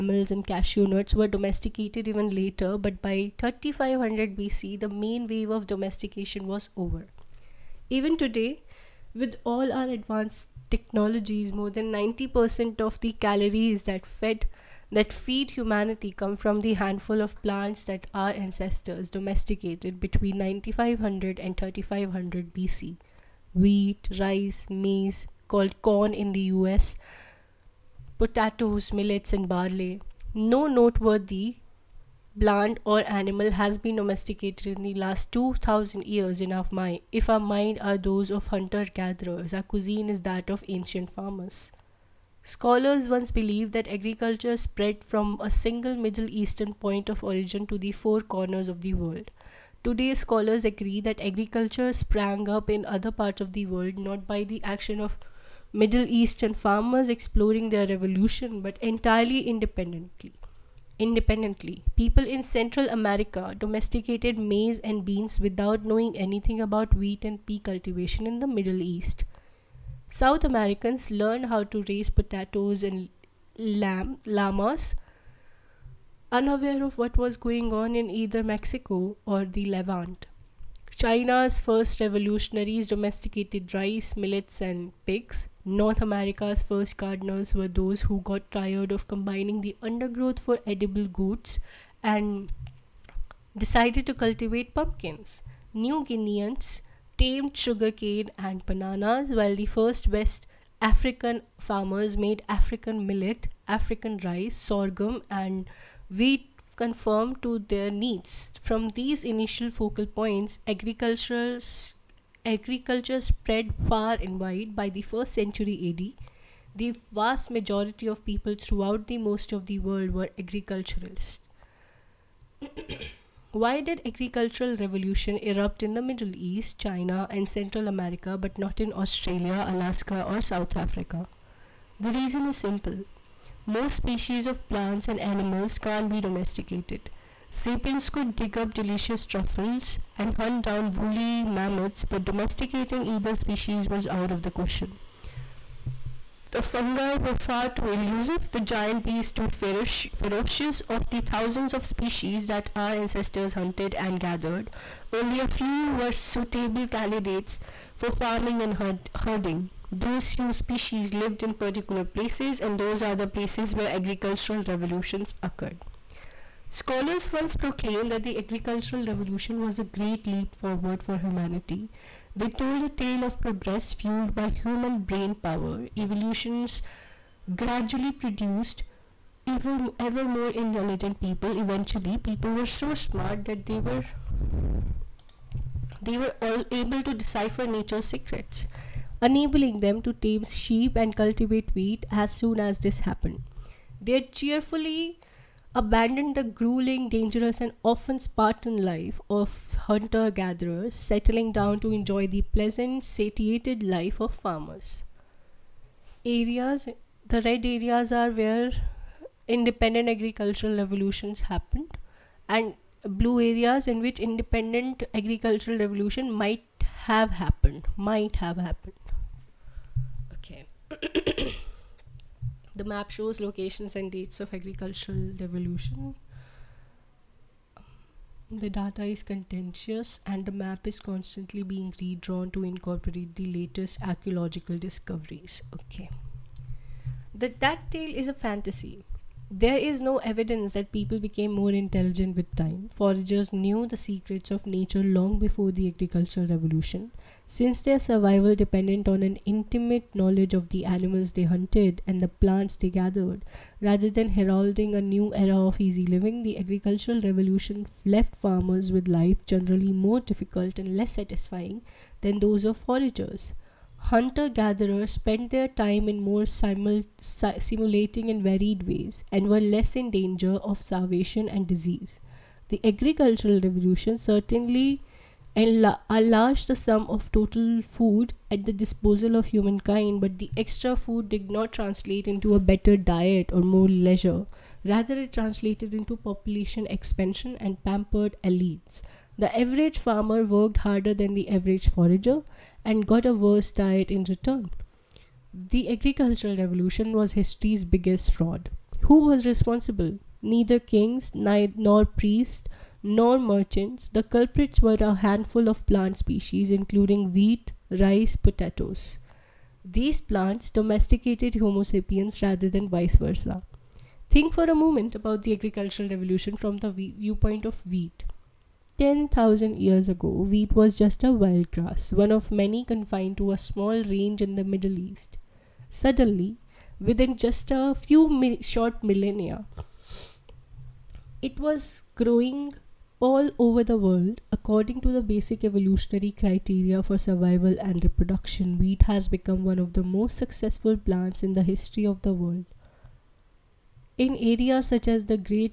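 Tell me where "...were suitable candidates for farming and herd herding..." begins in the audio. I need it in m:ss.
2:35.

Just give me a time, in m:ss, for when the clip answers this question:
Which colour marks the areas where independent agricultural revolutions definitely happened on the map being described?
3:27.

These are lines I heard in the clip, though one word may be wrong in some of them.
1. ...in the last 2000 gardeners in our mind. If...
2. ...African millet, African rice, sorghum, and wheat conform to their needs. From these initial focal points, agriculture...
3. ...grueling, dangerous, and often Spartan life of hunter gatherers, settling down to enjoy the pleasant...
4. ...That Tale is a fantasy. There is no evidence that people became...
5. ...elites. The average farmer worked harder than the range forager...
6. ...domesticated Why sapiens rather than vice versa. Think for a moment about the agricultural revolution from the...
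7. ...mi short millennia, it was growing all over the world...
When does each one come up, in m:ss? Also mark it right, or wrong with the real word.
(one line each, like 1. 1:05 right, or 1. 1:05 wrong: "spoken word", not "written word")
1. 0:34 wrong: "years", not "gardeners"
2. 1:42 right
3. 3:16 right
4. 3:57 right
5. 4:48 wrong: "average", not "range"
6. 5:10 wrong: "Homo", not "Why"
7. 5:28 right.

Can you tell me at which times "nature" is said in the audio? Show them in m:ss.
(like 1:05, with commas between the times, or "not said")
3:07, 4:04.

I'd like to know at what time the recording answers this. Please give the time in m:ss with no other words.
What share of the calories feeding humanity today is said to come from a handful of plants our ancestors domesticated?
0:11.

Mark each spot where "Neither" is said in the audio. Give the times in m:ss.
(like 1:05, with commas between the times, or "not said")
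5:00.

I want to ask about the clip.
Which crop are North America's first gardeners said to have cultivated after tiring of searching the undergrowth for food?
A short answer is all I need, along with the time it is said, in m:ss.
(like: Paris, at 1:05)
pumpkins, at 1:34.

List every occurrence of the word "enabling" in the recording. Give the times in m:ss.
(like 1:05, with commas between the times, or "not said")
3:09.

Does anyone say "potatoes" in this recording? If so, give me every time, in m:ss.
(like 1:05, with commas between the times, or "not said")
0:28, 1:12, 5:08.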